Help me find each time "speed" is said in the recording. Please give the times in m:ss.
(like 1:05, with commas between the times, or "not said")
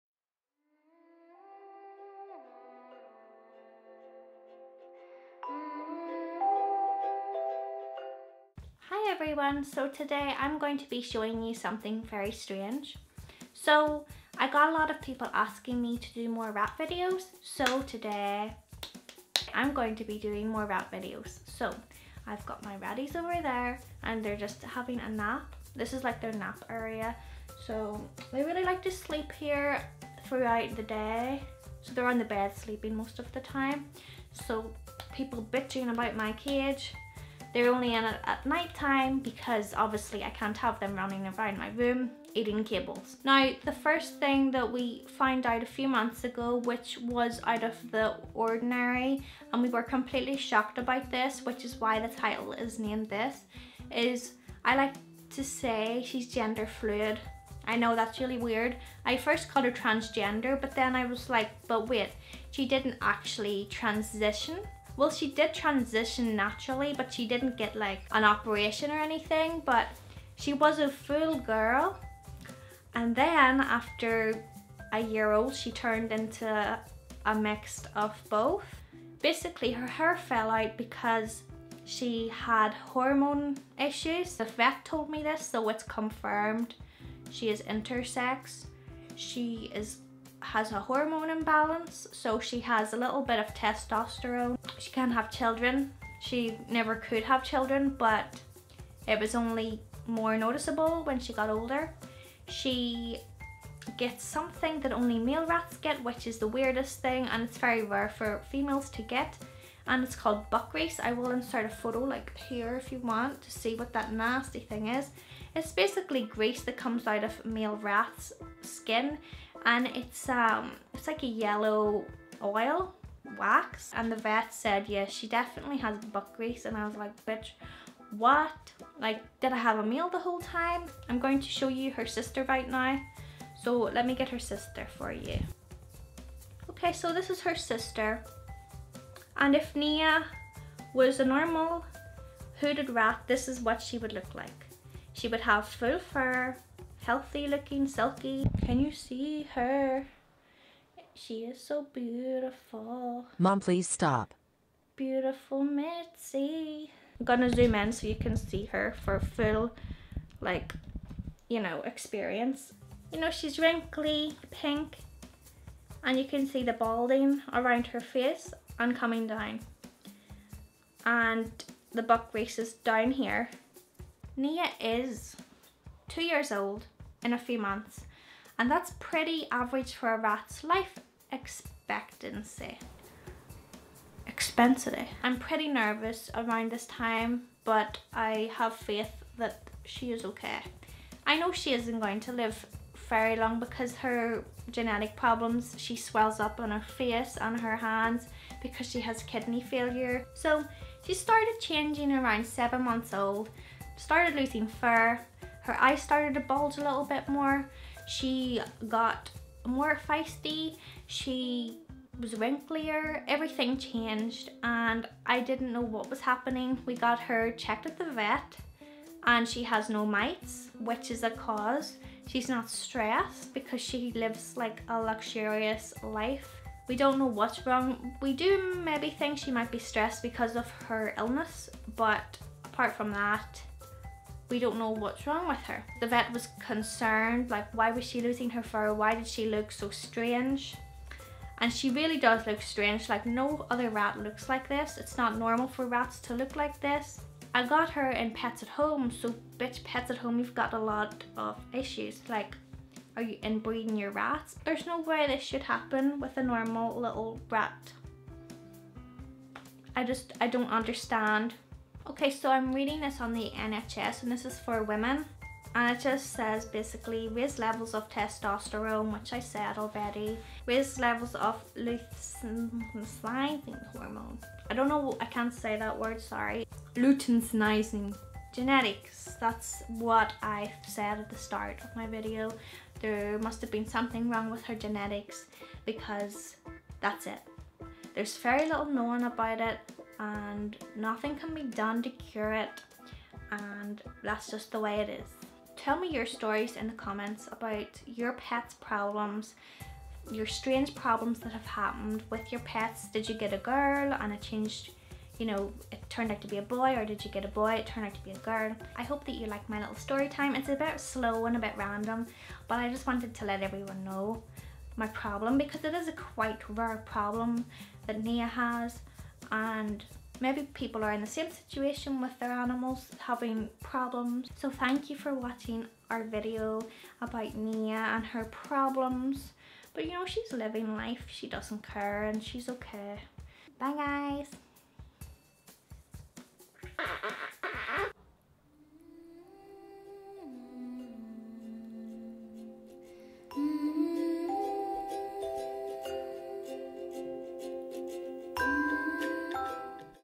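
not said.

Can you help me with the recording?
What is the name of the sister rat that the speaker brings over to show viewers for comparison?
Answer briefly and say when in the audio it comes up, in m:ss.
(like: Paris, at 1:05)
Mitzi, at 2:35.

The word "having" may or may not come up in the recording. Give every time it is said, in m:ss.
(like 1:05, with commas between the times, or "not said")
0:24, 5:23.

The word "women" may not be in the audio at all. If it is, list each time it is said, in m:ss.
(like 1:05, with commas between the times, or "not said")
4:24.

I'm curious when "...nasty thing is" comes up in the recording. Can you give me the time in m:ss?
1:54.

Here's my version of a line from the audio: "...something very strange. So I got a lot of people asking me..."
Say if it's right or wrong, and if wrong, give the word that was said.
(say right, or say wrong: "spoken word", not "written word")
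right.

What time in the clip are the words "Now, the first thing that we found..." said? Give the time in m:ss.
0:43.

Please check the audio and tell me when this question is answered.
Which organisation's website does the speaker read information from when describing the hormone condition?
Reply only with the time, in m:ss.
4:23.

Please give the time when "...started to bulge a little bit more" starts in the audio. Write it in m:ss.
3:26.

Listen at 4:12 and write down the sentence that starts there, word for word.
Like, are you inbreeding your rats?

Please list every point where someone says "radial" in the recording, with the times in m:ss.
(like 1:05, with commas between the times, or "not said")
not said.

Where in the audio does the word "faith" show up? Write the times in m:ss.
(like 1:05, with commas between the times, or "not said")
3:08.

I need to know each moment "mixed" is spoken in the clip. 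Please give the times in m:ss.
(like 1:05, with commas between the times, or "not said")
1:17.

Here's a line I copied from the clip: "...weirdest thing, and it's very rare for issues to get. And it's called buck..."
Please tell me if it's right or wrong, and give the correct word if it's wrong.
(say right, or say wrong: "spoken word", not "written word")
wrong: "females", not "issues".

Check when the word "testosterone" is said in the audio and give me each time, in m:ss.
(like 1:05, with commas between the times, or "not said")
1:33, 4:28.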